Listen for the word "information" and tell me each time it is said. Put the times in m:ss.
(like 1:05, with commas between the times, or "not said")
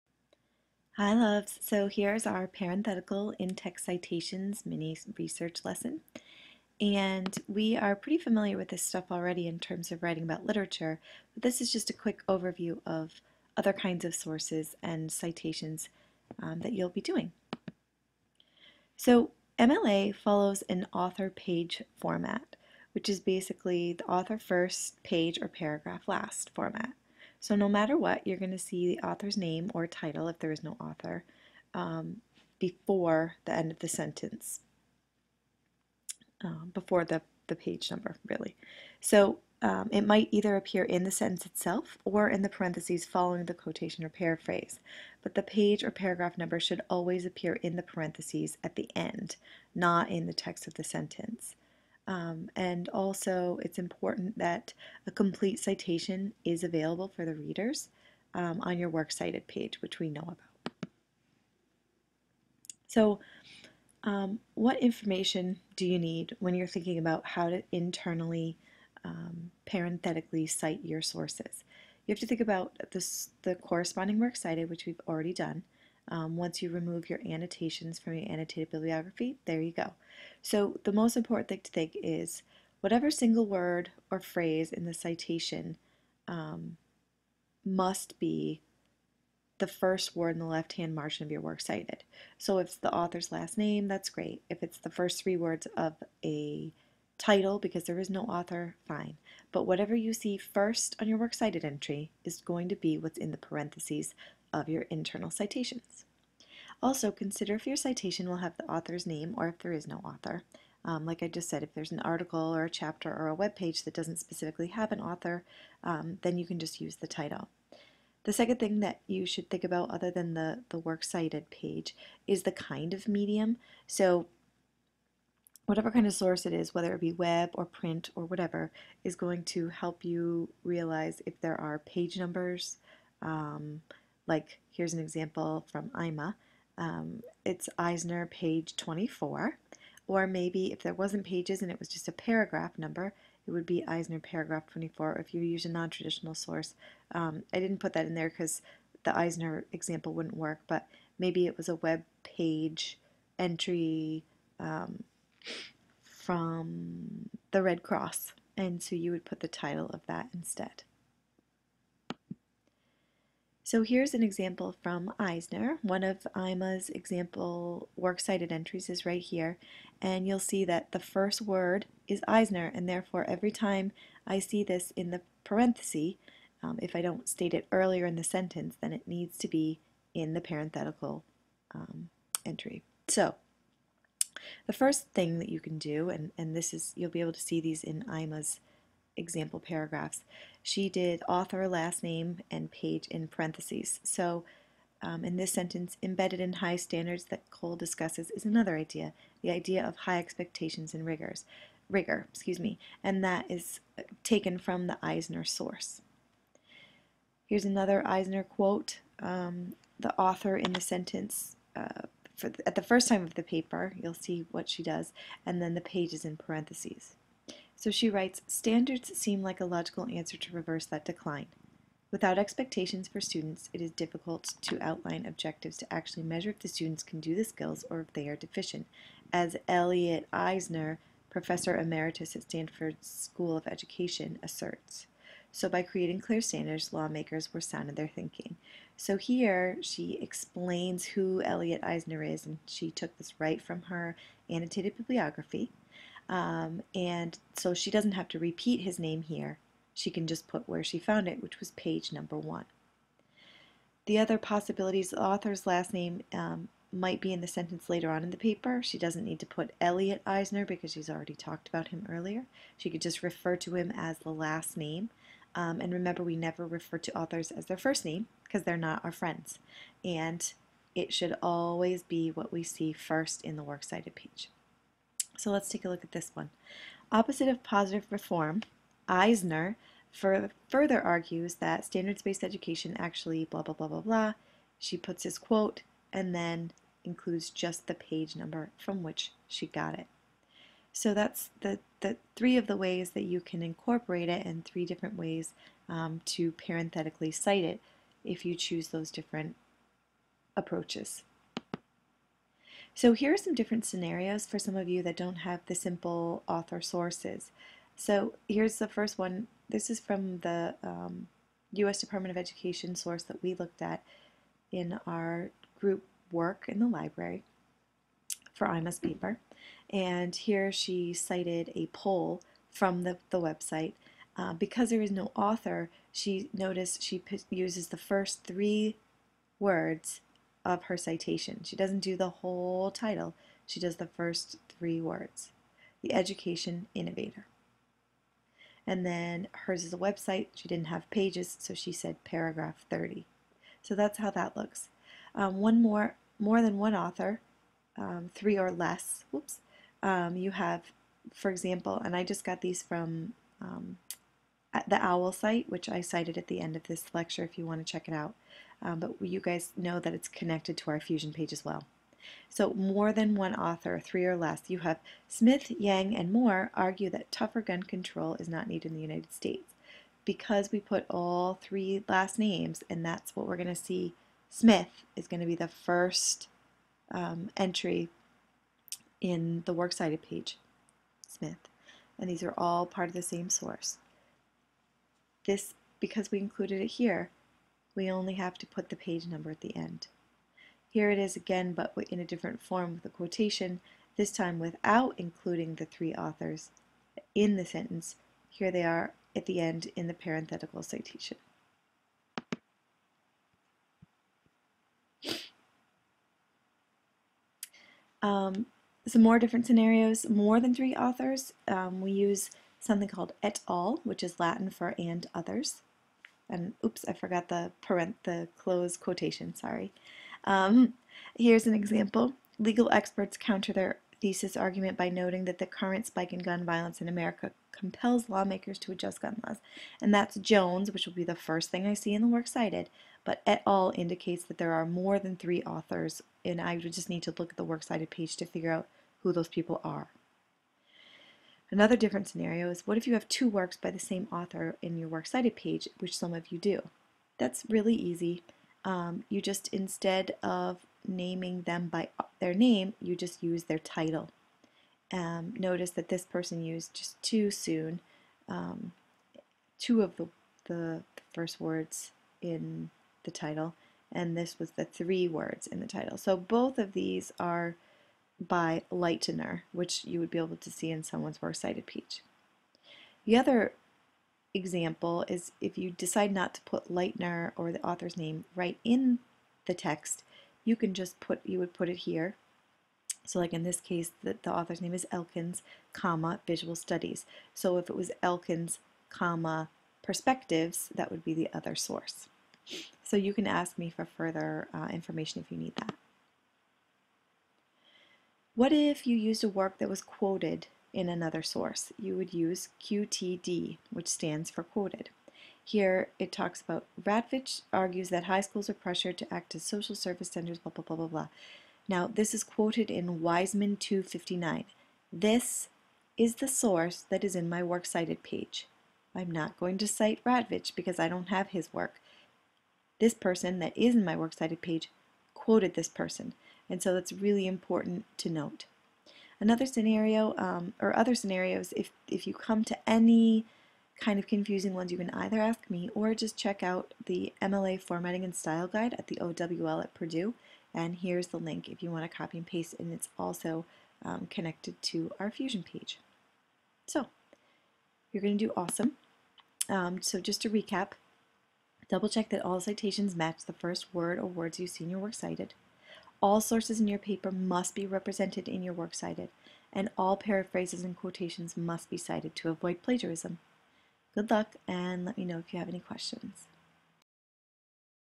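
1:04, 8:14.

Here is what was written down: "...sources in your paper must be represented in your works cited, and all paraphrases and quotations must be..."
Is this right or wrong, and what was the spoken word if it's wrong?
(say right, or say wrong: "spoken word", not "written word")
right.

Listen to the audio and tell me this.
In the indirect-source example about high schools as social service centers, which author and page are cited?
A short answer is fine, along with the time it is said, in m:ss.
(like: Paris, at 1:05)
Wiseman 259, at 8:33.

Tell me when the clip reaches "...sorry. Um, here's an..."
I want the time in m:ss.
6:59.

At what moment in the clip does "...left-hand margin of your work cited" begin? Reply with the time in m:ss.
1:30.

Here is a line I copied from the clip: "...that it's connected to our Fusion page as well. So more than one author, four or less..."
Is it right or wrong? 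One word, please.
wrong.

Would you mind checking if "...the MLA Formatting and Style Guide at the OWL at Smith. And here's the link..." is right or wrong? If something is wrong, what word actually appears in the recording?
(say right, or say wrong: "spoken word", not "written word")
wrong: "Purdue", not "Smith".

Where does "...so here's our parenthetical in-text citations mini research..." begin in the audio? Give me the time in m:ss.
0:01.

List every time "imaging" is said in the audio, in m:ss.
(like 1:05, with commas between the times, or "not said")
not said.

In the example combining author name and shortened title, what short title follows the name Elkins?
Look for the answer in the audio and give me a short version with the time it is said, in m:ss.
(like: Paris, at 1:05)
Visual Studies, at 8:06.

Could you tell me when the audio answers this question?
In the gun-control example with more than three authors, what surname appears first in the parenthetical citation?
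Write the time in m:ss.
7:10.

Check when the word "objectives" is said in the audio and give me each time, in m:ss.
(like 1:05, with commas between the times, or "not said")
3:45.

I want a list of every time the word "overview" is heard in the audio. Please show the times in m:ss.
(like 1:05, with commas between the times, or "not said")
0:12.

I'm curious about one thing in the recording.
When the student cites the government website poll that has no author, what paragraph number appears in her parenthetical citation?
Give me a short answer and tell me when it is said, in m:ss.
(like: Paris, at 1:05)
30, at 5:42.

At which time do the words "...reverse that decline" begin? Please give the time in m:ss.
3:40.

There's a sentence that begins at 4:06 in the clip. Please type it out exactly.
Um, and so she doesn't have to repeat his name here.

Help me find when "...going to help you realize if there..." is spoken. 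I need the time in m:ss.
2:09.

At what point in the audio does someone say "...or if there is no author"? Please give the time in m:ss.
1:49.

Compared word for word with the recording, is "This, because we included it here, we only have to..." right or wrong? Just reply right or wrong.
right.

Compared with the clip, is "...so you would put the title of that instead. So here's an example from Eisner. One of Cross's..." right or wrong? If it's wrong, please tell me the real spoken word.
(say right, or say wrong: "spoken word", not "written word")
wrong: "IMA", not "Cross".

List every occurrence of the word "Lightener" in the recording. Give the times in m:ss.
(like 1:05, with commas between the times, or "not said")
7:48, 7:56.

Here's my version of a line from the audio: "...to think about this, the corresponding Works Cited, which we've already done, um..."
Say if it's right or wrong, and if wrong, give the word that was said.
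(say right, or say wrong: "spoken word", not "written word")
right.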